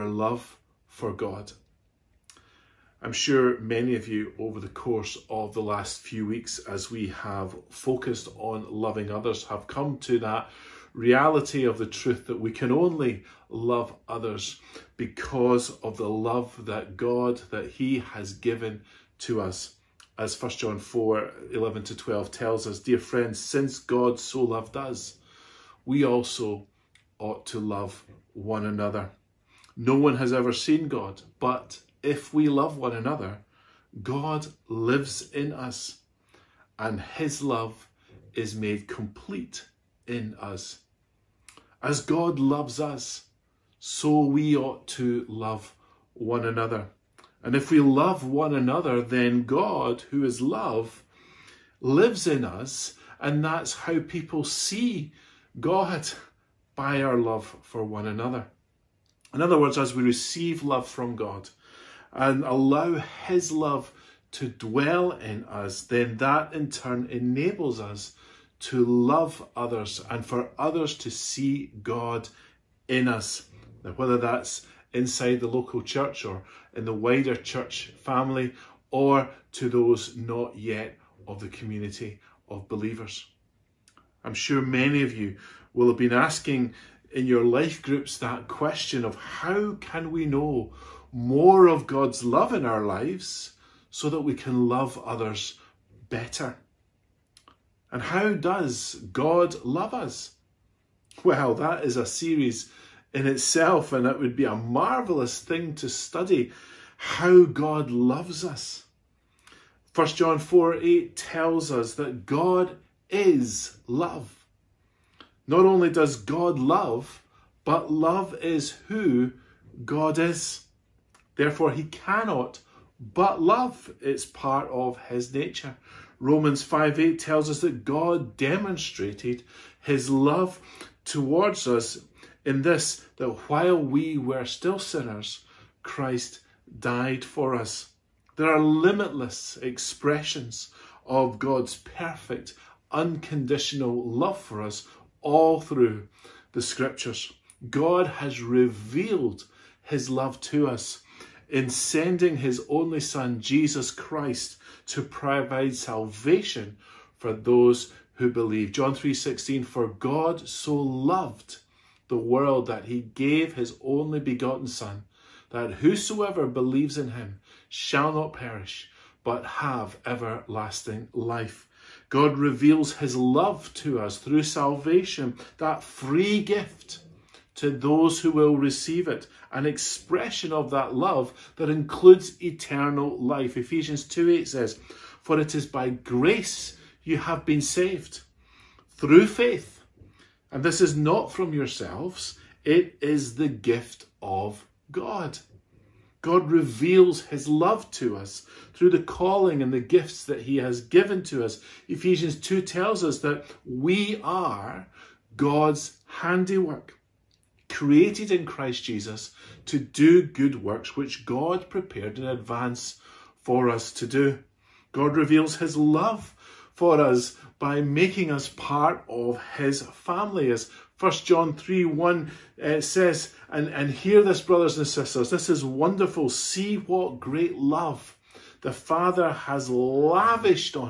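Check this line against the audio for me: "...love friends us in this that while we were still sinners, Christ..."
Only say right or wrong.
wrong.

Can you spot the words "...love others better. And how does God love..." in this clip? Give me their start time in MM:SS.
01:34.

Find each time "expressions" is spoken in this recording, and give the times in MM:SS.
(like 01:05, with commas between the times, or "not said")
02:19, 02:59.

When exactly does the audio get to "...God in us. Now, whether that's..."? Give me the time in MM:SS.
01:11.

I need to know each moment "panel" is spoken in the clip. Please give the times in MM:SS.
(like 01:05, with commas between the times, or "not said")
not said.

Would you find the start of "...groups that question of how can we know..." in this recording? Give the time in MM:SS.
01:27.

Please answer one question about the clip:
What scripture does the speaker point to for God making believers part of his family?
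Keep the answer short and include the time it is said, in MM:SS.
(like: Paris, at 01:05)
1 John 3:1, at 03:40.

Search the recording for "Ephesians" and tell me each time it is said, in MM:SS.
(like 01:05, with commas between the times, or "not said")
03:03, 03:21.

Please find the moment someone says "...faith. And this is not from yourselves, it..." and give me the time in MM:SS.
03:09.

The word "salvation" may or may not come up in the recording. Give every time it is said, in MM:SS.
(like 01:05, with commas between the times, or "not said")
02:35, 02:54.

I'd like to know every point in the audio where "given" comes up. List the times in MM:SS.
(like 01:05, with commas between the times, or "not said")
00:18, 03:20.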